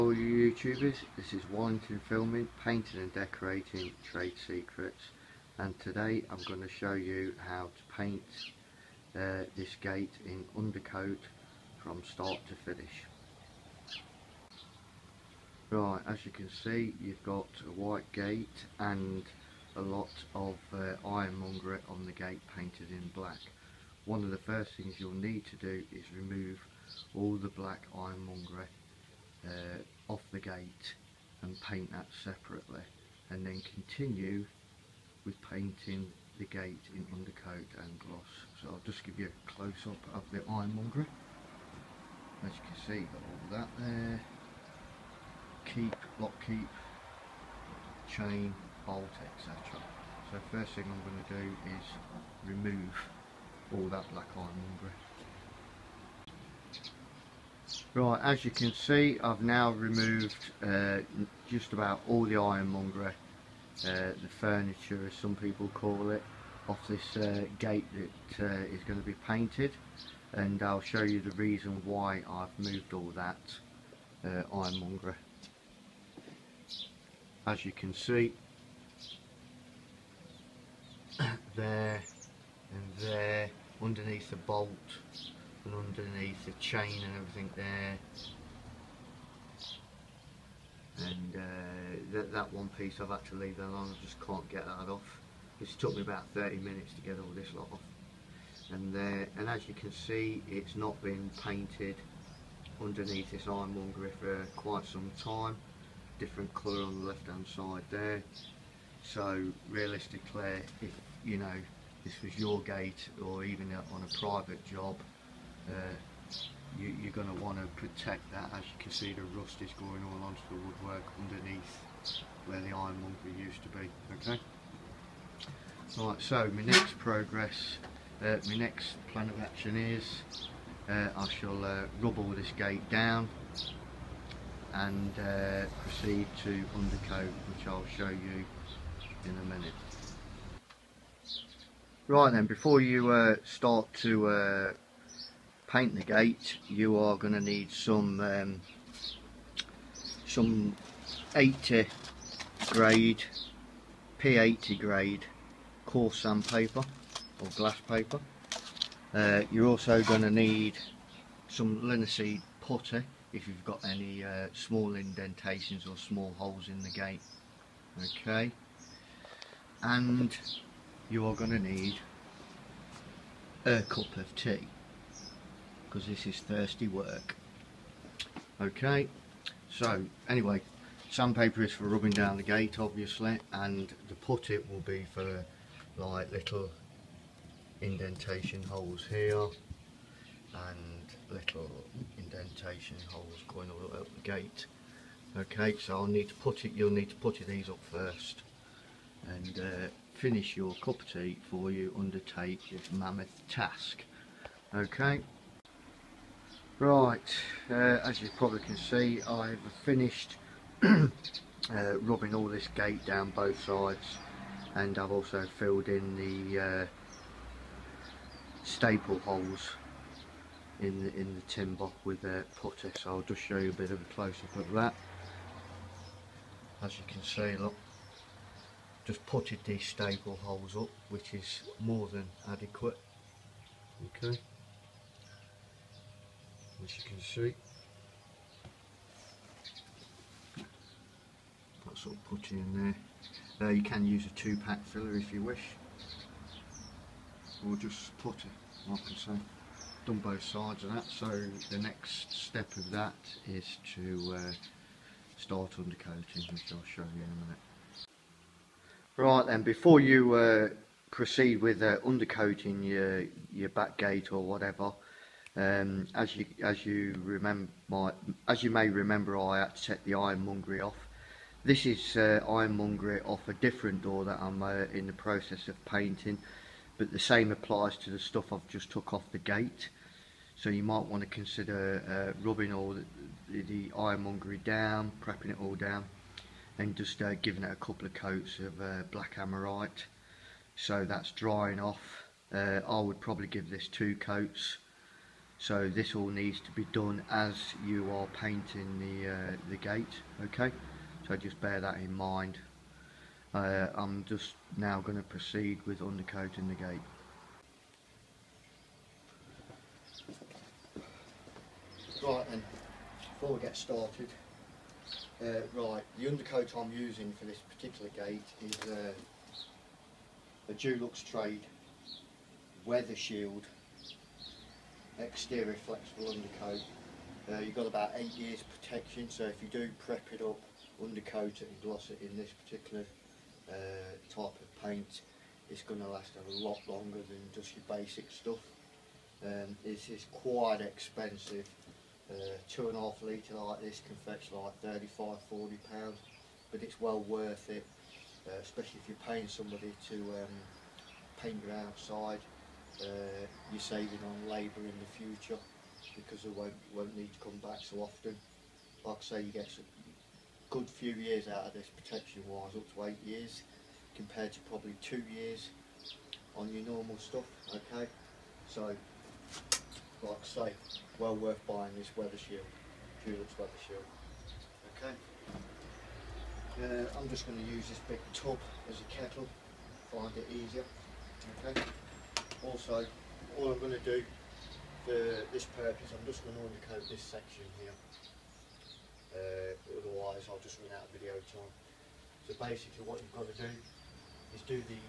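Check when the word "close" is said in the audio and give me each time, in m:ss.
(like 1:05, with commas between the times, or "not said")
0:39, 3:44.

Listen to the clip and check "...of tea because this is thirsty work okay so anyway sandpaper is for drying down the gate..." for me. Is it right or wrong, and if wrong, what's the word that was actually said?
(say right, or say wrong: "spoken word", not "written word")
wrong: "rubbing", not "drying".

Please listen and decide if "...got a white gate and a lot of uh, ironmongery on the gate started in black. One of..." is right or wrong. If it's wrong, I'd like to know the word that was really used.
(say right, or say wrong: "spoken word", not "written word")
wrong: "painted", not "started".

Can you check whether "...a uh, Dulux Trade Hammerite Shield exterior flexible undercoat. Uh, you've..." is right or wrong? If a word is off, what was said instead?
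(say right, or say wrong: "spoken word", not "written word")
wrong: "Weather", not "Hammerite".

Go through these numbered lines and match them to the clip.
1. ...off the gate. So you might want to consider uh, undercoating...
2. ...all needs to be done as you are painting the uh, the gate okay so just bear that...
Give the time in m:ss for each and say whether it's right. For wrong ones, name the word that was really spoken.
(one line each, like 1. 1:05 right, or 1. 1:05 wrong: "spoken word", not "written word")
1. 4:39 wrong: "rubbing", not "undercoating"
2. 4:56 right.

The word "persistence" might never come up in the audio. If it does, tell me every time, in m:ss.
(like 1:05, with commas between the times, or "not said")
not said.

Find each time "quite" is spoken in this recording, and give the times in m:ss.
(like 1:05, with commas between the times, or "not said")
1:44, 5:40.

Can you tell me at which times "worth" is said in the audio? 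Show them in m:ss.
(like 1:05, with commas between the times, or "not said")
5:47, 6:11.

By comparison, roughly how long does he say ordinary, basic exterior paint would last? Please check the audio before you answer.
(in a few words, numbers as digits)
2 years.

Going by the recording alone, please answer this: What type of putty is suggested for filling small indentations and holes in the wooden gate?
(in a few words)
linseed putty.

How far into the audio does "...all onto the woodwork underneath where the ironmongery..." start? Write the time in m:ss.
2:00.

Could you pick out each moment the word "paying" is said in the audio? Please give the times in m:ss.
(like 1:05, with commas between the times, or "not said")
5:49.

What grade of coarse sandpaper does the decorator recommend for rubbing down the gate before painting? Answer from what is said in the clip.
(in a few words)
P80.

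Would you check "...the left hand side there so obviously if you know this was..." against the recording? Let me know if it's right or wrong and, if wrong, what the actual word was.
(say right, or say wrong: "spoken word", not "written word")
wrong: "realistically", not "obviously".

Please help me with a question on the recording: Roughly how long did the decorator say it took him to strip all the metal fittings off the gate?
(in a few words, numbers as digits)
30 minutes.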